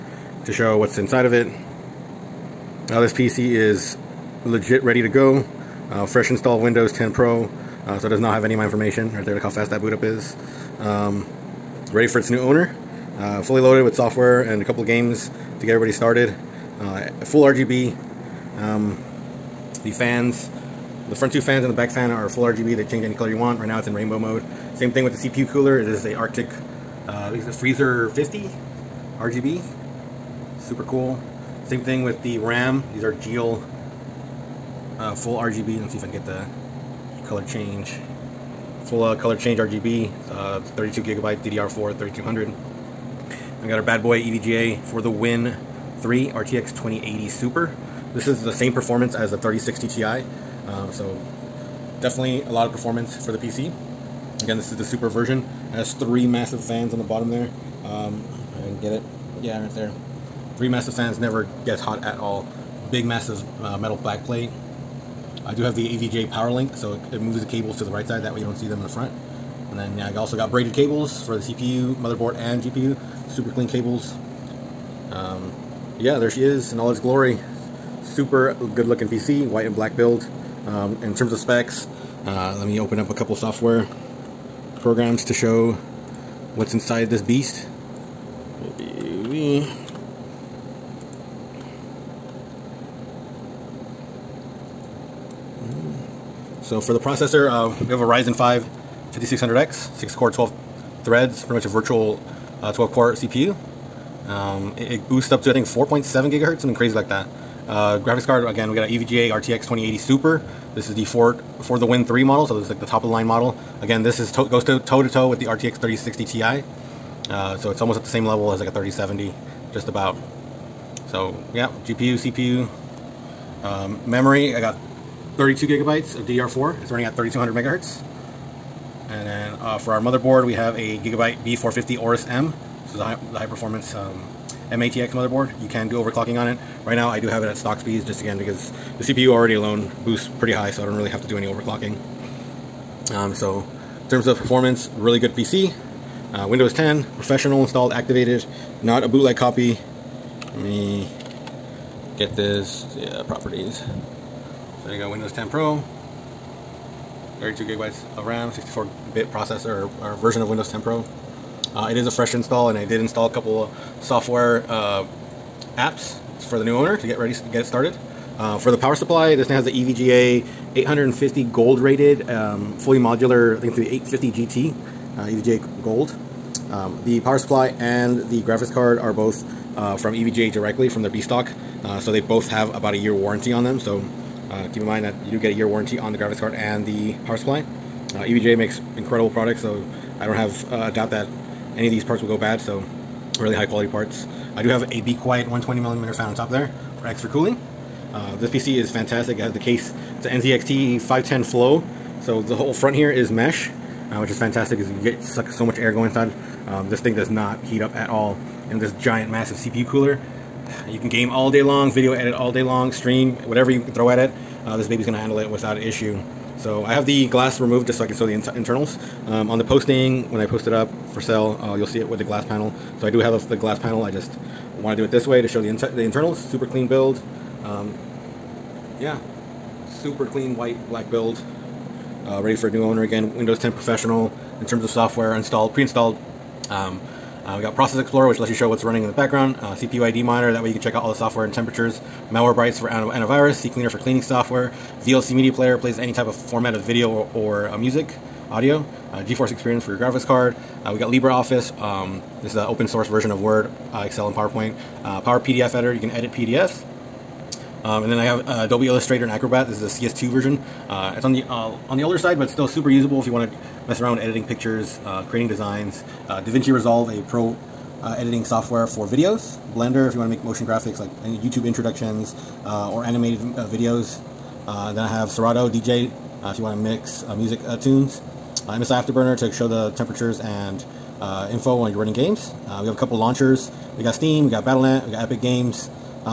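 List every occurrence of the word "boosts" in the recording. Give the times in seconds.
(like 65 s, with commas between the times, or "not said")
105 s, 140 s.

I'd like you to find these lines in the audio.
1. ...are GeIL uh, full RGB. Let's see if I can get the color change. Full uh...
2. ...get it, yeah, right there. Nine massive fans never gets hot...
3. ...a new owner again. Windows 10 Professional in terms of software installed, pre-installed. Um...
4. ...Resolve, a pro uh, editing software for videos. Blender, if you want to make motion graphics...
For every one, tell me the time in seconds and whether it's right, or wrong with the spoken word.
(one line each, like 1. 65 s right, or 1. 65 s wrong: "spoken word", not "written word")
1. 33 s right
2. 58 s wrong: "Three", not "Nine"
3. 232 s right
4. 266 s right.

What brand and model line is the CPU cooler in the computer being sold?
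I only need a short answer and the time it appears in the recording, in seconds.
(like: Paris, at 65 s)
Arctic Freezer 50 RGB, at 27 s.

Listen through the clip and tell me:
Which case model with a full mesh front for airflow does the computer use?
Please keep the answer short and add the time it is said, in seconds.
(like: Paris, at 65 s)
NZXT 510 Flow, at 200 s.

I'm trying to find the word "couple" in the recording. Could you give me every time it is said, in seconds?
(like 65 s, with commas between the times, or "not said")
14 s, 83 s, 163 s, 282 s.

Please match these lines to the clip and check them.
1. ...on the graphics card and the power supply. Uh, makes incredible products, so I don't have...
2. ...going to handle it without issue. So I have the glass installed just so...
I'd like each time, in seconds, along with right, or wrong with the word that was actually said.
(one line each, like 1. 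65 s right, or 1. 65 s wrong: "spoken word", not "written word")
1. 185 s right
2. 215 s wrong: "removed", not "installed".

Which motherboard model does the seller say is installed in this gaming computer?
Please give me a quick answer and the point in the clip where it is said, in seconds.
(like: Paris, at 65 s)
Gigabyte B450 Aorus M, at 130 s.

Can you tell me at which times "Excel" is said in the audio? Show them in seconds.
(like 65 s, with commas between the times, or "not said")
254 s.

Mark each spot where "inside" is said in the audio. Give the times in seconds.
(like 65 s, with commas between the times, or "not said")
0 s, 86 s, 206 s.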